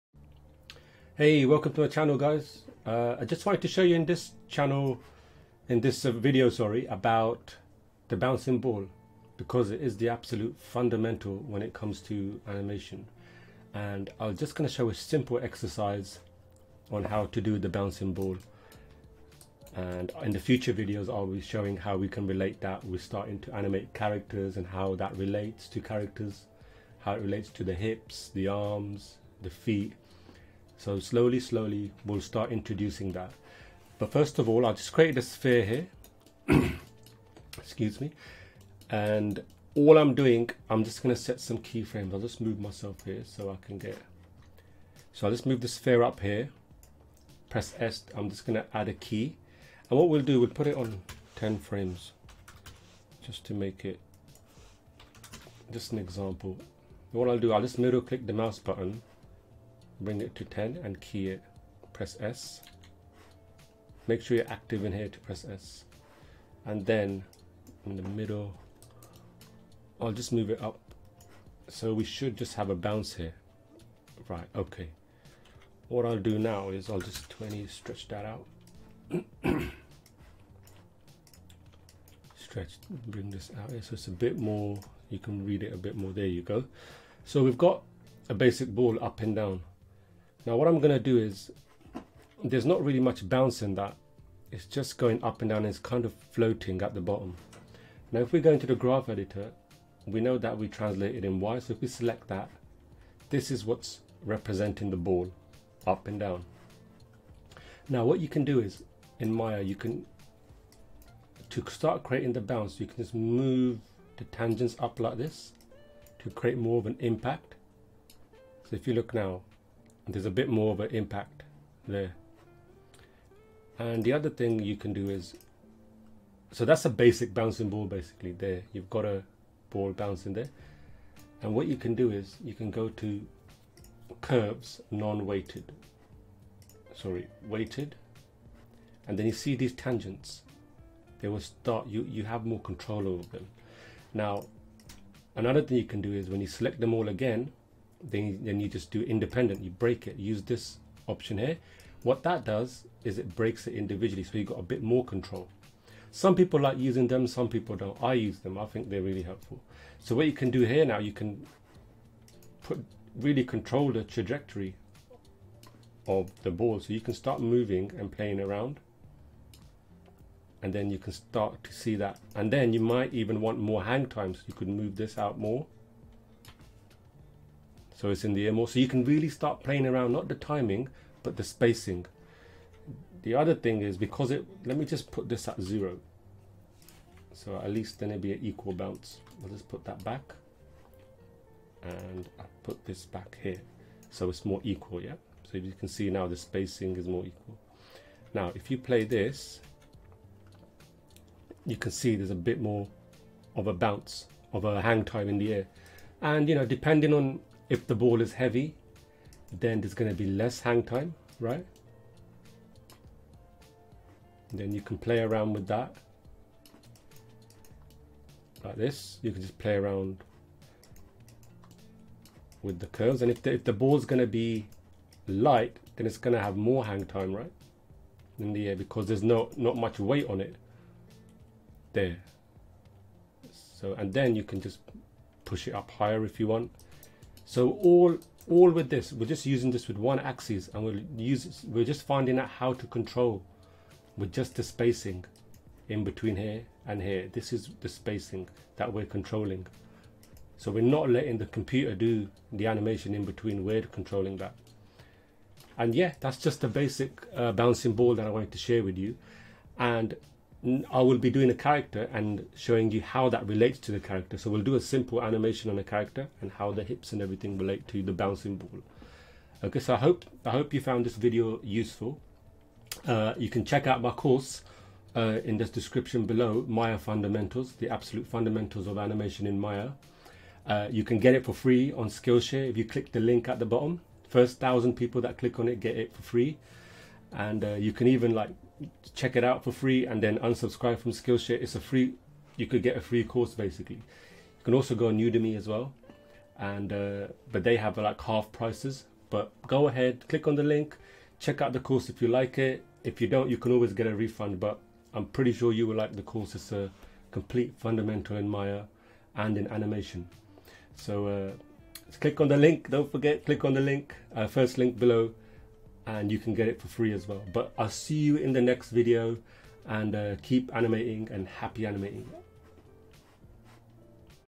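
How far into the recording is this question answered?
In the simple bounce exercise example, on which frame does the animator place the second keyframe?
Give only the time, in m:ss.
0:51.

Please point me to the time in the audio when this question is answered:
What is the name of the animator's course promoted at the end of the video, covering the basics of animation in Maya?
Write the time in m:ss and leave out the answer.
4:36.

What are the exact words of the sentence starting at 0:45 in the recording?
So I'll just move the sphere up here.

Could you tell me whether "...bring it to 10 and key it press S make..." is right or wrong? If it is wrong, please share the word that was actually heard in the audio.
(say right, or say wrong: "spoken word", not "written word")
right.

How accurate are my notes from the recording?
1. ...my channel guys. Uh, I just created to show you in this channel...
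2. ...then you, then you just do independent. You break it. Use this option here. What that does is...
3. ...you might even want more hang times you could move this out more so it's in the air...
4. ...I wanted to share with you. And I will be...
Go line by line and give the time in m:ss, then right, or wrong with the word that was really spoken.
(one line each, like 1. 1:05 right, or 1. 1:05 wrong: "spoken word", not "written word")
1. 0:01 wrong: "wanted", not "created"
2. 2:28 right
3. 2:52 right
4. 4:18 right.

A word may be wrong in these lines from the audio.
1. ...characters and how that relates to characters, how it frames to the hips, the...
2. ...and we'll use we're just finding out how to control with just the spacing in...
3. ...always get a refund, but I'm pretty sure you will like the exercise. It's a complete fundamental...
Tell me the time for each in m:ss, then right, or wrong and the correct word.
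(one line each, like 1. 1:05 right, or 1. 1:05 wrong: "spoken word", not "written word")
1. 0:23 wrong: "relates", not "frames"
2. 4:00 right
3. 5:03 wrong: "course", not "exercise".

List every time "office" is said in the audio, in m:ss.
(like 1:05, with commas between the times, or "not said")
not said.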